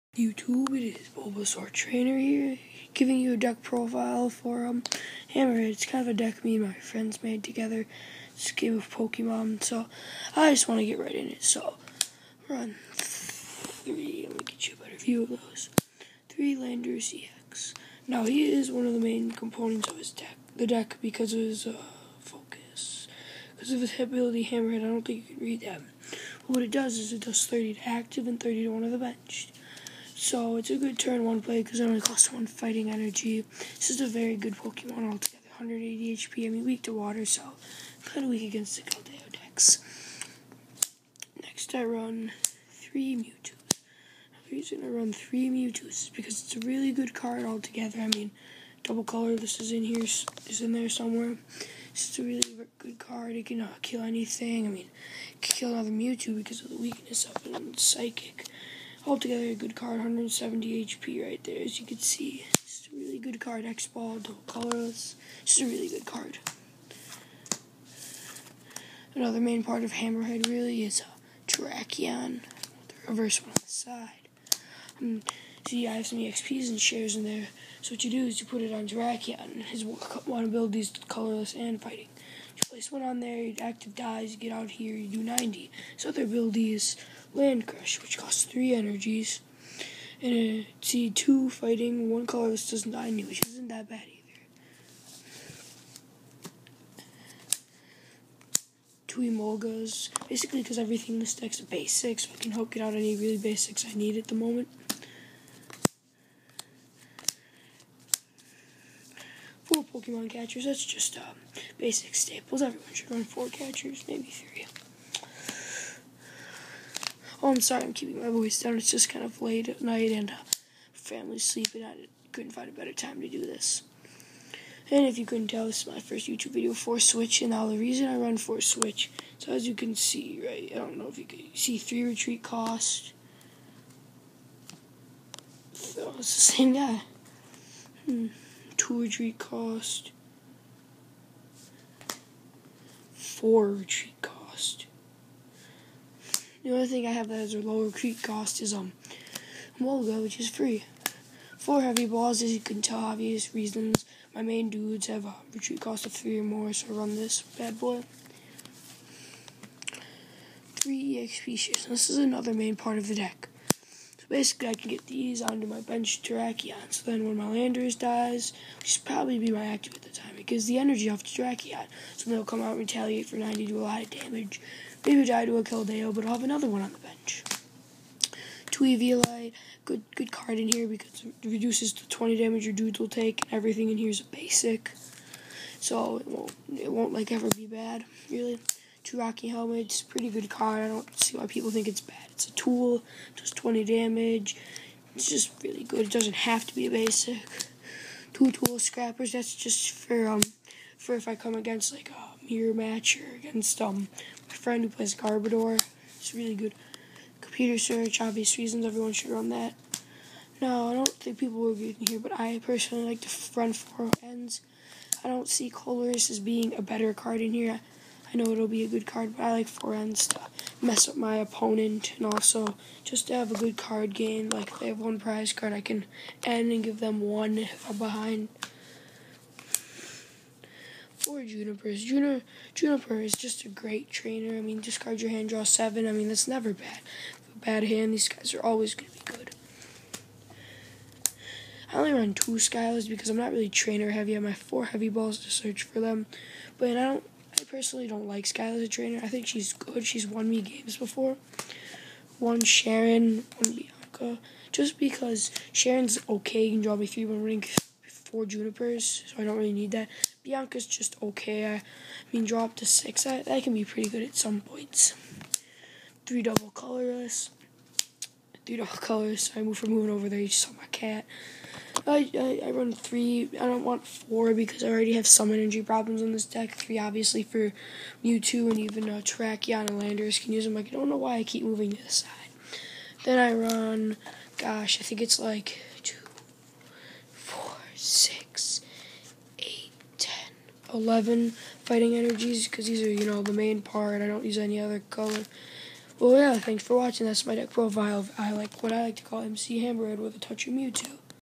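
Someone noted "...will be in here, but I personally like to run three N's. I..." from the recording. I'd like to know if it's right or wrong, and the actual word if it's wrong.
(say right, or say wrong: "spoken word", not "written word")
wrong: "four", not "three".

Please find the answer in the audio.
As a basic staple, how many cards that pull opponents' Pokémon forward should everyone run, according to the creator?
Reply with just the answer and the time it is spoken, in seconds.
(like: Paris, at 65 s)
4, at 113 s.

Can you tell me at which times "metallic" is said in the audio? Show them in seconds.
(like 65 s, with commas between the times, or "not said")
not said.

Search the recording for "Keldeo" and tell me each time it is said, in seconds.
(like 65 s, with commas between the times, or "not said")
38 s, 175 s.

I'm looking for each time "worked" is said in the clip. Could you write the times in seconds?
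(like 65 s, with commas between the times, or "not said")
not said.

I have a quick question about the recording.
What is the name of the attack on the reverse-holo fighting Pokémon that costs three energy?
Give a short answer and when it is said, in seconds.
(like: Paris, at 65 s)
Land Crush, at 87 s.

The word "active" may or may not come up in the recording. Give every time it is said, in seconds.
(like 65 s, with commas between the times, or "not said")
27 s, 83 s, 169 s.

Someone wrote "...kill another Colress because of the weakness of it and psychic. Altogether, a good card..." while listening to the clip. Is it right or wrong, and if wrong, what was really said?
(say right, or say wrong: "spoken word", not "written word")
wrong: "Mewtwo", not "Colress".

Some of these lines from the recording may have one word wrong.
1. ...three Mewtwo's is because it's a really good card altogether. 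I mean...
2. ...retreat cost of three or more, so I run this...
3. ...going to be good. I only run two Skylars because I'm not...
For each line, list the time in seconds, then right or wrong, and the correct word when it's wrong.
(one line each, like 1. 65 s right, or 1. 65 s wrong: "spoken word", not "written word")
1. 45 s right
2. 155 s right
3. 238 s right.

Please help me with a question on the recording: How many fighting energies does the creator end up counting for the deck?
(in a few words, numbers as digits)
11.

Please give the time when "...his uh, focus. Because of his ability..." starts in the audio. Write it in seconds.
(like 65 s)
21 s.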